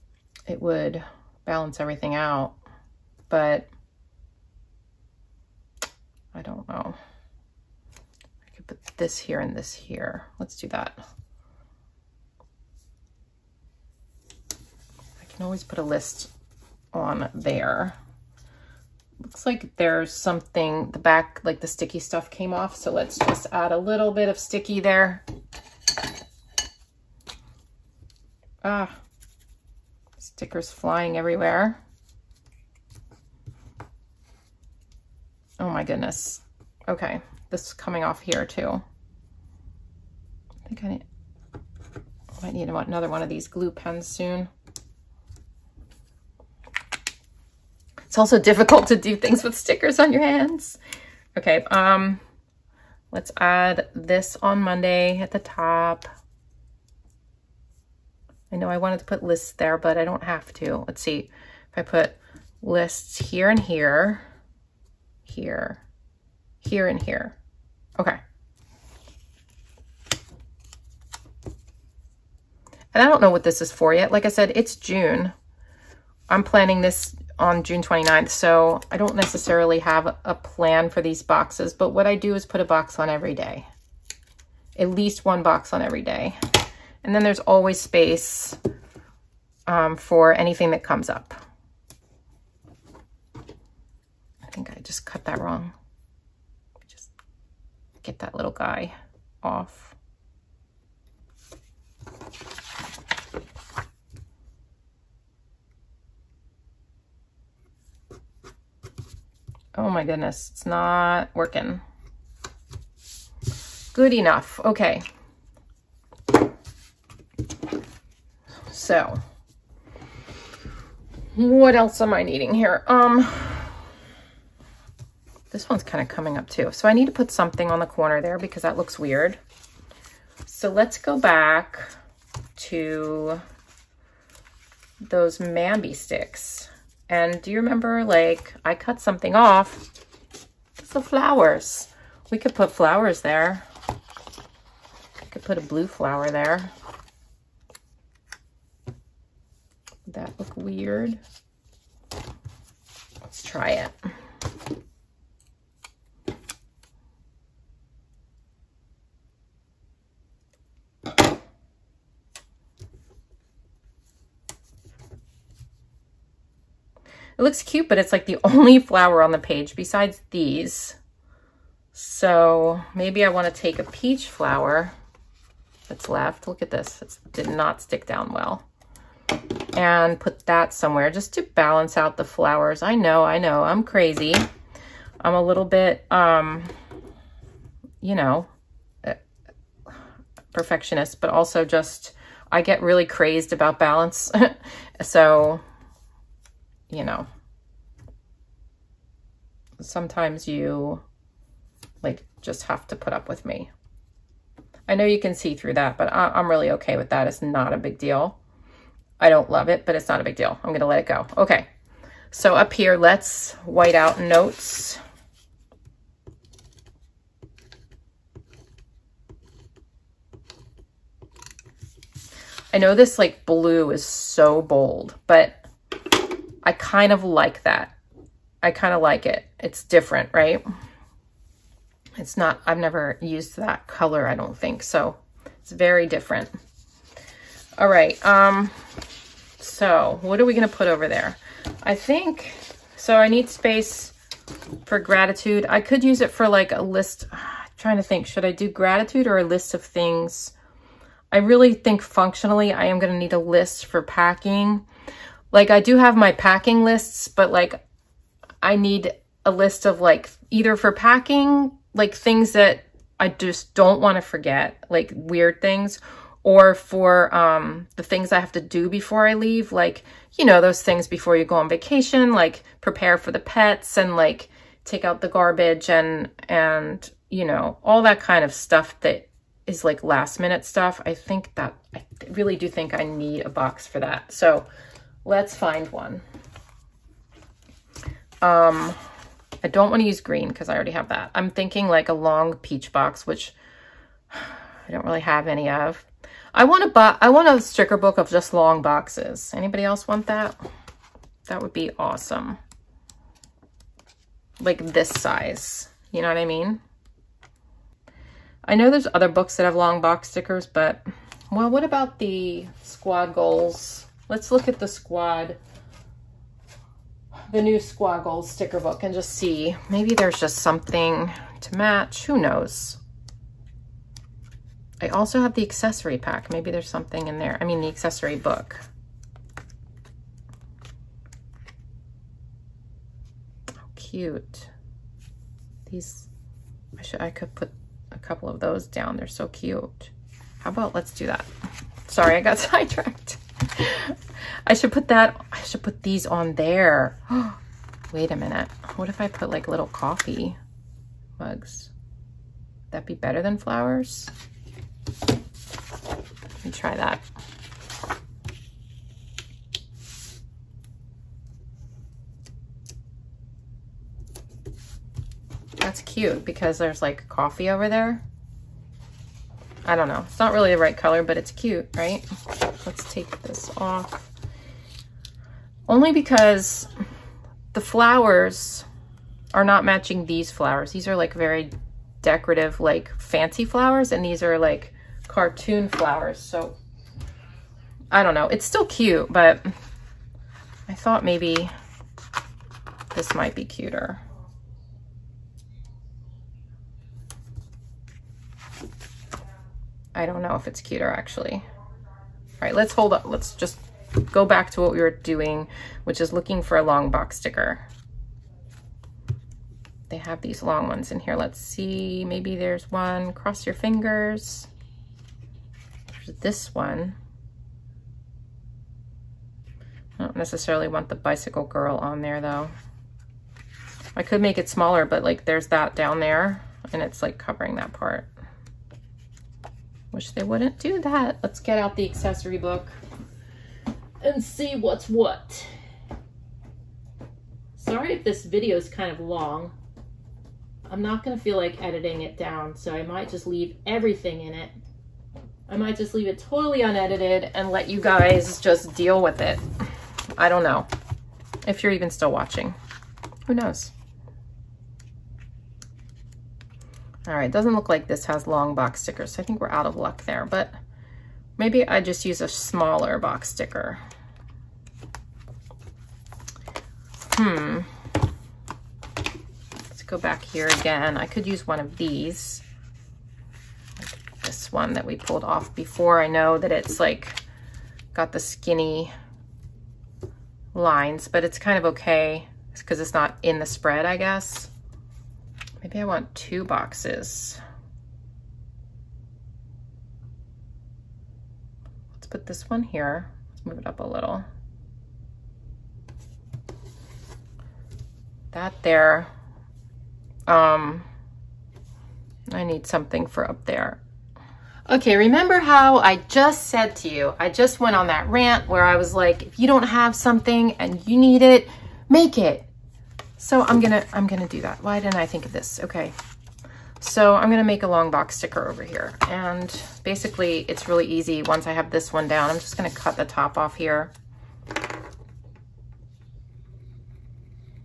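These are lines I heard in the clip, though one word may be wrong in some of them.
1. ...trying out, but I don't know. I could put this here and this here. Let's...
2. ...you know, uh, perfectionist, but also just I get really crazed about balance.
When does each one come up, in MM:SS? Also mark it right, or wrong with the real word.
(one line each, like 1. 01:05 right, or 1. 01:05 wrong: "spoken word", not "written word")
1. 00:01 wrong: "everything", not "trying"
2. 03:08 right.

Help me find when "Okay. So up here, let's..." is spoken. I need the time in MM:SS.
03:31.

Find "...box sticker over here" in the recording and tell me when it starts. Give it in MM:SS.
08:38.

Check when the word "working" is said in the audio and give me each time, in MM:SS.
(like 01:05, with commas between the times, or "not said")
01:51.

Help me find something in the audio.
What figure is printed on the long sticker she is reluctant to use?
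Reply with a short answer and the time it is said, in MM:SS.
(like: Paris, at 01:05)
Bicycle girl, at 07:01.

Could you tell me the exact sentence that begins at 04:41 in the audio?
I think that, I really do think I need a box for that.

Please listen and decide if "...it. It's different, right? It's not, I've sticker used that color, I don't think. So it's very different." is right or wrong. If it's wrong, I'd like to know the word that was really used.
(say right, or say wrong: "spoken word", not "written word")
wrong: "never", not "sticker".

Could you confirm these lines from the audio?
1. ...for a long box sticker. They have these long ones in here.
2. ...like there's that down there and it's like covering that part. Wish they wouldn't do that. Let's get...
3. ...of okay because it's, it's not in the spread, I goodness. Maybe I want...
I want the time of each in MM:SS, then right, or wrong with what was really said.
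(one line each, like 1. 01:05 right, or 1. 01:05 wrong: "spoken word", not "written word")
1. 06:46 right
2. 07:05 right
3. 08:01 wrong: "guess", not "goodness".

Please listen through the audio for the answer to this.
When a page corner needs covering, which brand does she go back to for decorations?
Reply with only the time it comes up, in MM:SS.
02:15.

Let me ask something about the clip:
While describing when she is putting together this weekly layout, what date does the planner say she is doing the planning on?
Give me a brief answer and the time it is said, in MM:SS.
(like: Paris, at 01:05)
June 29th, at 01:17.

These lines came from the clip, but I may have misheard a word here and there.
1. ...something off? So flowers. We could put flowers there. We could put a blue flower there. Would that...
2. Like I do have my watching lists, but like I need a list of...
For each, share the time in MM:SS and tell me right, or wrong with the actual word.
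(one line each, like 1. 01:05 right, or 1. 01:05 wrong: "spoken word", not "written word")
1. 02:18 right
2. 04:15 wrong: "packing", not "watching".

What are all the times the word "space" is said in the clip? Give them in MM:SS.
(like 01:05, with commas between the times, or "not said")
01:27, 04:03.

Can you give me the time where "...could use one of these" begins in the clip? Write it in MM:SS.
07:51.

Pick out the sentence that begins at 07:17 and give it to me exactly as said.
Sorry if this video is kind of long.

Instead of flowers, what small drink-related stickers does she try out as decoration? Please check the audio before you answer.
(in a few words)
Coffee mugs.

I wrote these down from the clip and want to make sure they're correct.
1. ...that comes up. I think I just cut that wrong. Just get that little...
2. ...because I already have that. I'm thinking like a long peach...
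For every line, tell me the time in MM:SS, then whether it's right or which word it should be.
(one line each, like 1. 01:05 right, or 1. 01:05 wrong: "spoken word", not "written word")
1. 01:30 right
2. 04:50 right.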